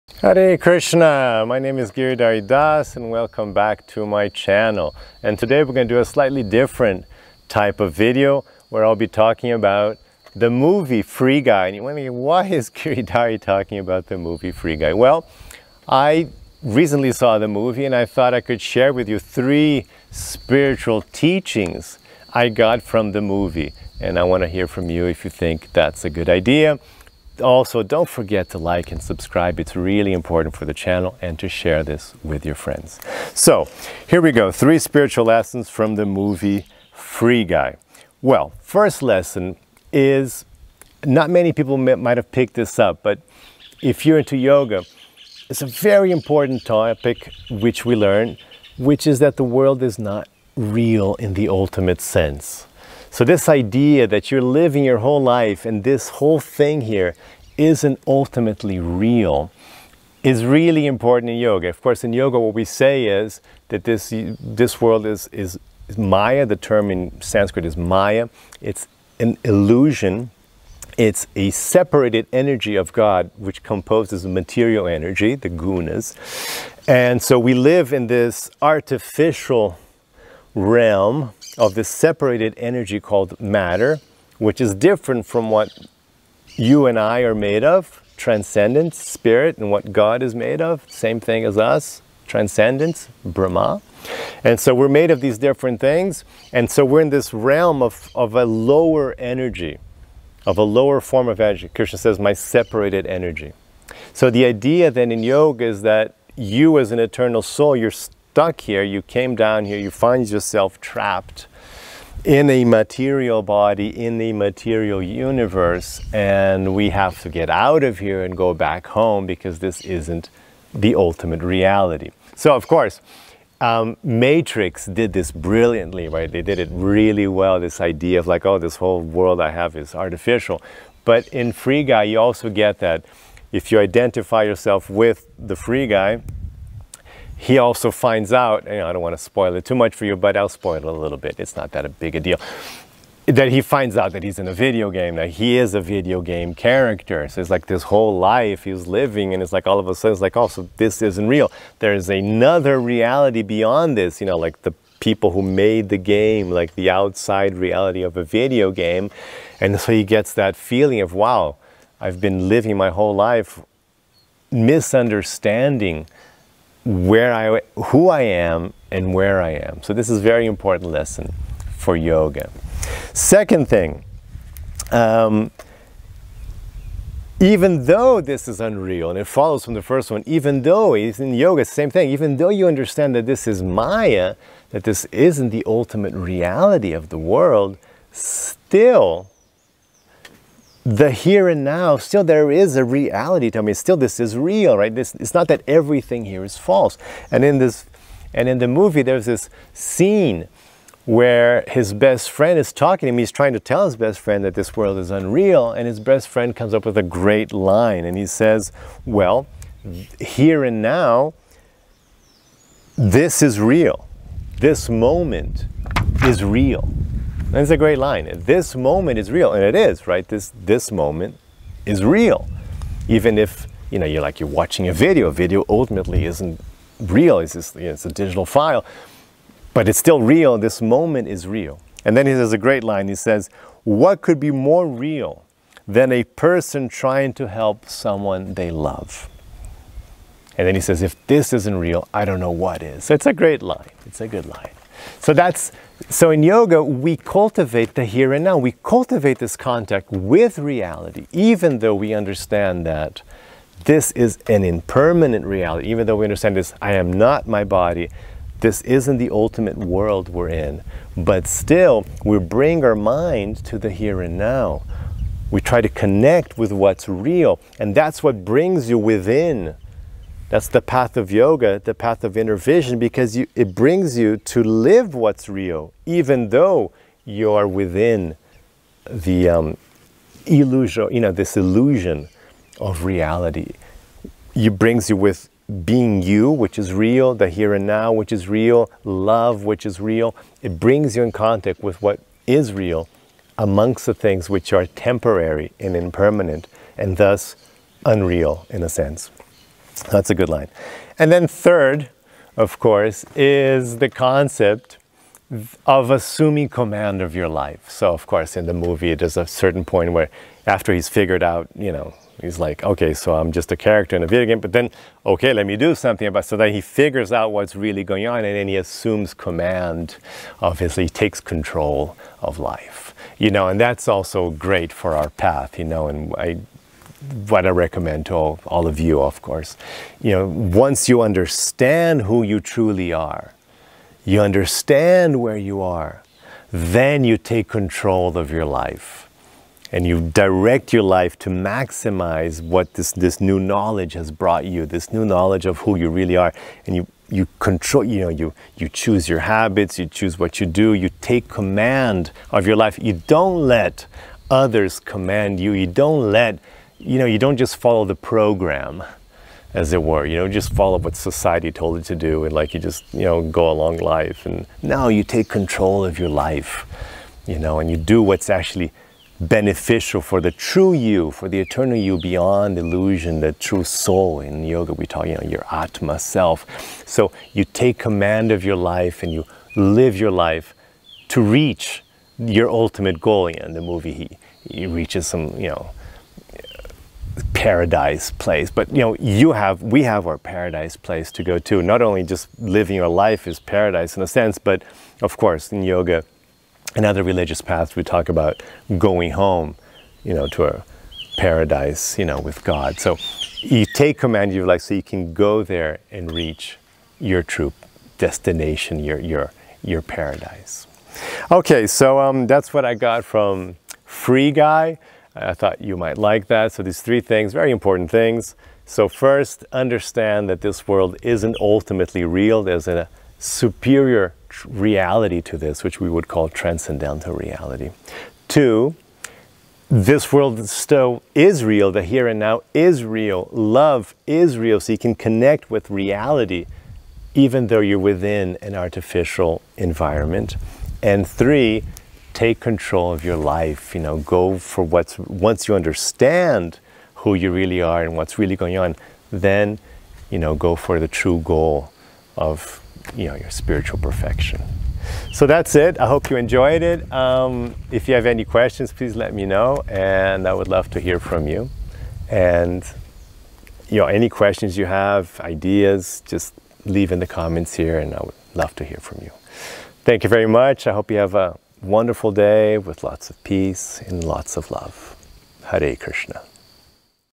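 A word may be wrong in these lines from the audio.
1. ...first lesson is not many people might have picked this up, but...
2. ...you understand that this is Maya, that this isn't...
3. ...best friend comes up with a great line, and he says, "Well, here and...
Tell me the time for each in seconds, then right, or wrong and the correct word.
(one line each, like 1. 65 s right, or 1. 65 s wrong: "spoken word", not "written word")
1. 38 s right
2. 182 s right
3. 205 s right.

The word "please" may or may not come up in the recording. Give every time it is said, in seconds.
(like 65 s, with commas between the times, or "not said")
458 s.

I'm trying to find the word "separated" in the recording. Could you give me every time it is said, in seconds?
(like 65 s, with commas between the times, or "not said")
71 s, 81 s, 102 s.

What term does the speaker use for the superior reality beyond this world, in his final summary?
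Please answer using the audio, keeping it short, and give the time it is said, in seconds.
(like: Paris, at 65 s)
transcendental reality, at 426 s.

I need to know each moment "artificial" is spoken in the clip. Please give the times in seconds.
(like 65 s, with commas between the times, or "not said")
78 s, 129 s, 438 s.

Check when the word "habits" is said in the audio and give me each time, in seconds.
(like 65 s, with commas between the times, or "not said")
349 s.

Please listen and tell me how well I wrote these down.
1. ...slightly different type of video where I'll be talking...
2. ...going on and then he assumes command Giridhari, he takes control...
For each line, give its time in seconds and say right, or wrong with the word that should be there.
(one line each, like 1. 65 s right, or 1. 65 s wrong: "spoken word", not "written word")
1. 6 s right
2. 318 s wrong: "Obviously", not "Giridhari".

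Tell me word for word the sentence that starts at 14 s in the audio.
Well, I recently saw the movie and I thought I could share with you three spiritual teachings I got from the movie.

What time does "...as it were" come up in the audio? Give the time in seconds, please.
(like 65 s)
359 s.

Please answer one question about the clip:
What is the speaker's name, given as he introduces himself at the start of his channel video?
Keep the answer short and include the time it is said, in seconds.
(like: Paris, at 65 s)
Giridhari Das, at 1 s.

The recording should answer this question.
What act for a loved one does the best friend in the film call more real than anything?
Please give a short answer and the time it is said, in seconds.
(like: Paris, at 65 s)
trying to help, at 236 s.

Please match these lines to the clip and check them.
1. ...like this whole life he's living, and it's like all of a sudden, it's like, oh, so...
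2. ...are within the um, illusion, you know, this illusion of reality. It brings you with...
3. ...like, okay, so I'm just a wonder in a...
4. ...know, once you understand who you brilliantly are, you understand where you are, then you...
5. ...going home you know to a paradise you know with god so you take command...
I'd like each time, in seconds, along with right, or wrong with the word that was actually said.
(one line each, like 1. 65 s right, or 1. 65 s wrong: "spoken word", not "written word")
1. 147 s right
2. 277 s right
3. 312 s wrong: "character", not "wonder"
4. 330 s wrong: "truly", not "brilliantly"
5. 398 s right.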